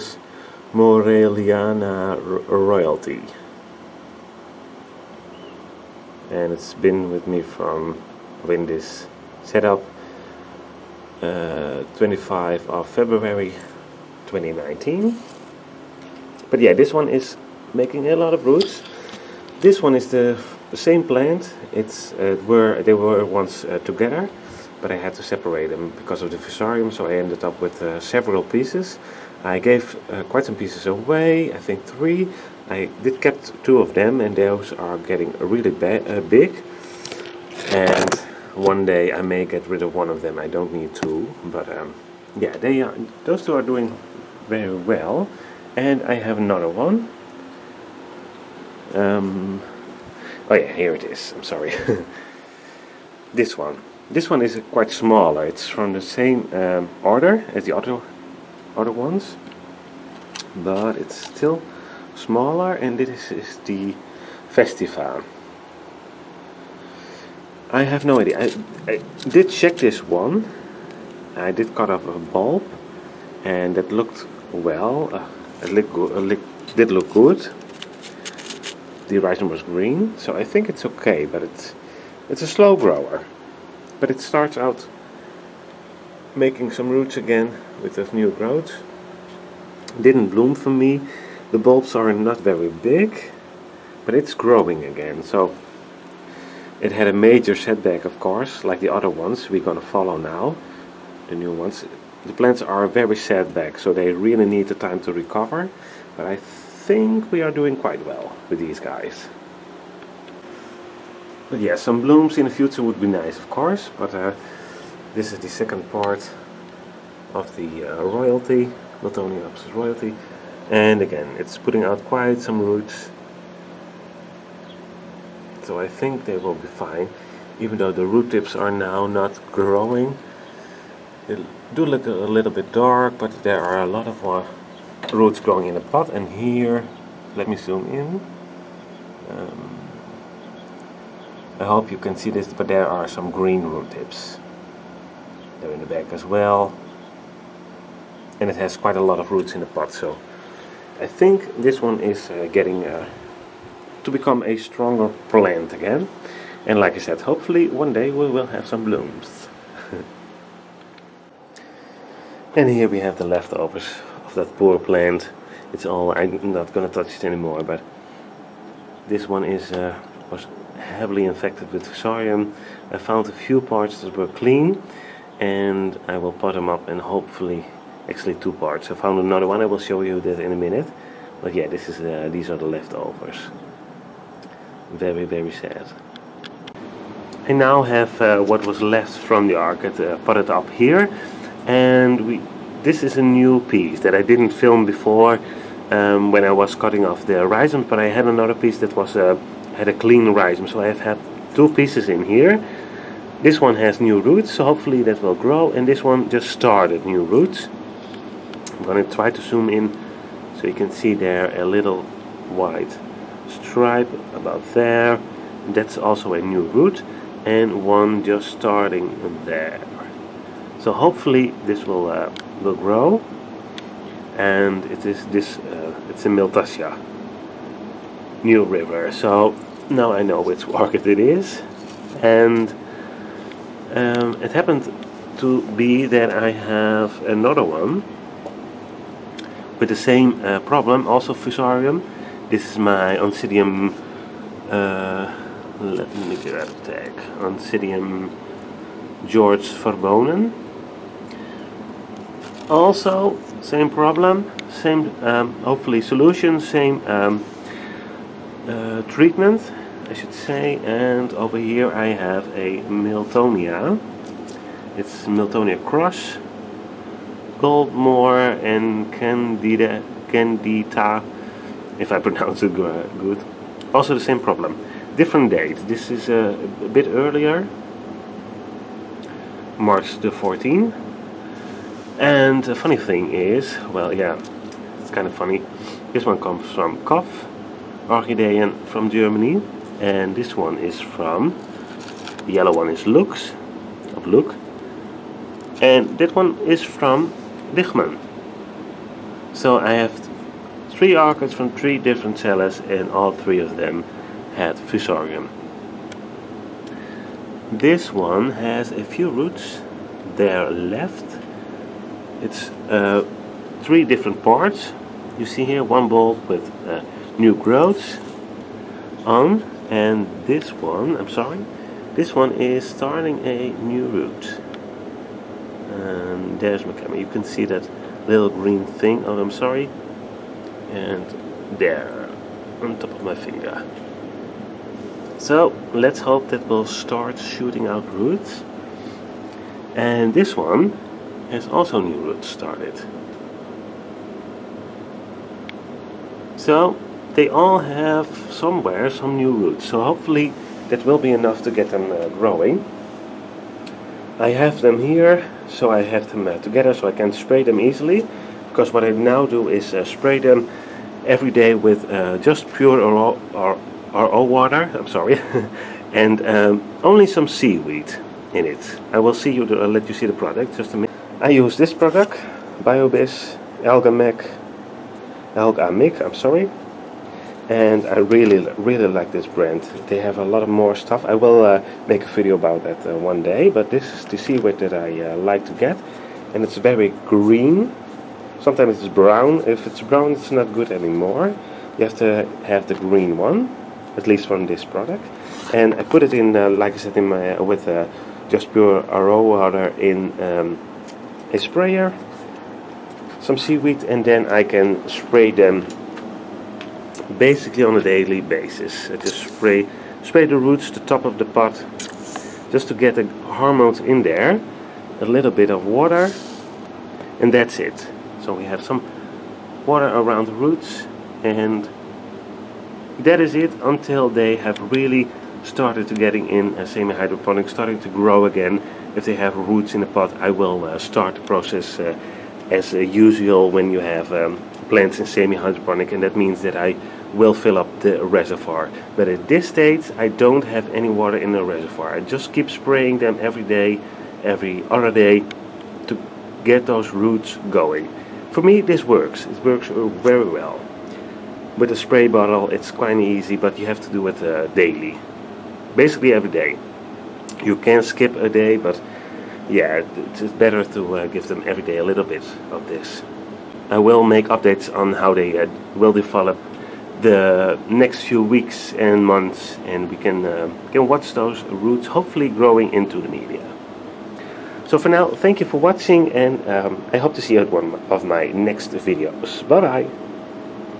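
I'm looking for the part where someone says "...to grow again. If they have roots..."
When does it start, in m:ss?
7:07.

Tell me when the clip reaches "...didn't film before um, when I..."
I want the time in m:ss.
3:14.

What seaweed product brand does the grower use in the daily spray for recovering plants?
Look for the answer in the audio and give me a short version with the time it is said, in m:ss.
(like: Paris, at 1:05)
BioBizz, at 6:12.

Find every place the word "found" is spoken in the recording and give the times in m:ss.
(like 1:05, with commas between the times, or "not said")
2:52, 2:58.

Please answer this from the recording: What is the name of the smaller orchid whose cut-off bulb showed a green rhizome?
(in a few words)
Festival.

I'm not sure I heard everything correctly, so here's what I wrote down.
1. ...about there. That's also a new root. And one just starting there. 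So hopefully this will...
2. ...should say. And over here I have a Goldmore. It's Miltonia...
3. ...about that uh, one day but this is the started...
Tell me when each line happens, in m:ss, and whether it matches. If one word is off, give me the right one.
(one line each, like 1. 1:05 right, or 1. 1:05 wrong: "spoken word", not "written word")
1. 3:34 right
2. 4:20 wrong: "Miltonia", not "Goldmore"
3. 6:22 wrong: "seaweed", not "started".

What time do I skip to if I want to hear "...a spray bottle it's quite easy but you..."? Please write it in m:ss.
7:31.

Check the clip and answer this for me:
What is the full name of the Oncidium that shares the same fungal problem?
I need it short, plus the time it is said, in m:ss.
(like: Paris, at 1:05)
Oncidium George Verbonen, at 4:07.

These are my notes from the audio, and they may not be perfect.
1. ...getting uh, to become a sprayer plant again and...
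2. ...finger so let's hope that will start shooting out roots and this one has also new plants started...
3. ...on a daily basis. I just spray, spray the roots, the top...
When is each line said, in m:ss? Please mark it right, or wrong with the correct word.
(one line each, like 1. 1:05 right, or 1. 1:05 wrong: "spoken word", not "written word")
1. 2:32 wrong: "stronger", not "sprayer"
2. 5:33 wrong: "roots", not "plants"
3. 6:47 right.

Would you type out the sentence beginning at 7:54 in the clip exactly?
So for now, thank you for watching, and um, I hope to see you at one of my next videos.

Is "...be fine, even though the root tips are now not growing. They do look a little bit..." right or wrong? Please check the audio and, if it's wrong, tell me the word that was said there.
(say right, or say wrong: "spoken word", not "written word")
right.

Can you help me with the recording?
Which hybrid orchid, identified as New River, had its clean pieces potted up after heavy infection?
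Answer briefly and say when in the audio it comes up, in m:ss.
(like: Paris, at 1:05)
Miltassia, at 3:46.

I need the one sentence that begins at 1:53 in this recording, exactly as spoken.
But uh, this is the second part of the uh, royalty, not only the royalty.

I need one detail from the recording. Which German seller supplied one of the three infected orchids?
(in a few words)
Kopf Orchideen.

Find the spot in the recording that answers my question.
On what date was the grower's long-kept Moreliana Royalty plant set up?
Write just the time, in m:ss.
0:11.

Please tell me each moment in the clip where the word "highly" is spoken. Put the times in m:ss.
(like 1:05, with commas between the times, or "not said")
not said.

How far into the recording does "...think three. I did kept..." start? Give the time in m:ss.
0:31.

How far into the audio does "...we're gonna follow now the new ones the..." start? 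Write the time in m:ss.
1:39.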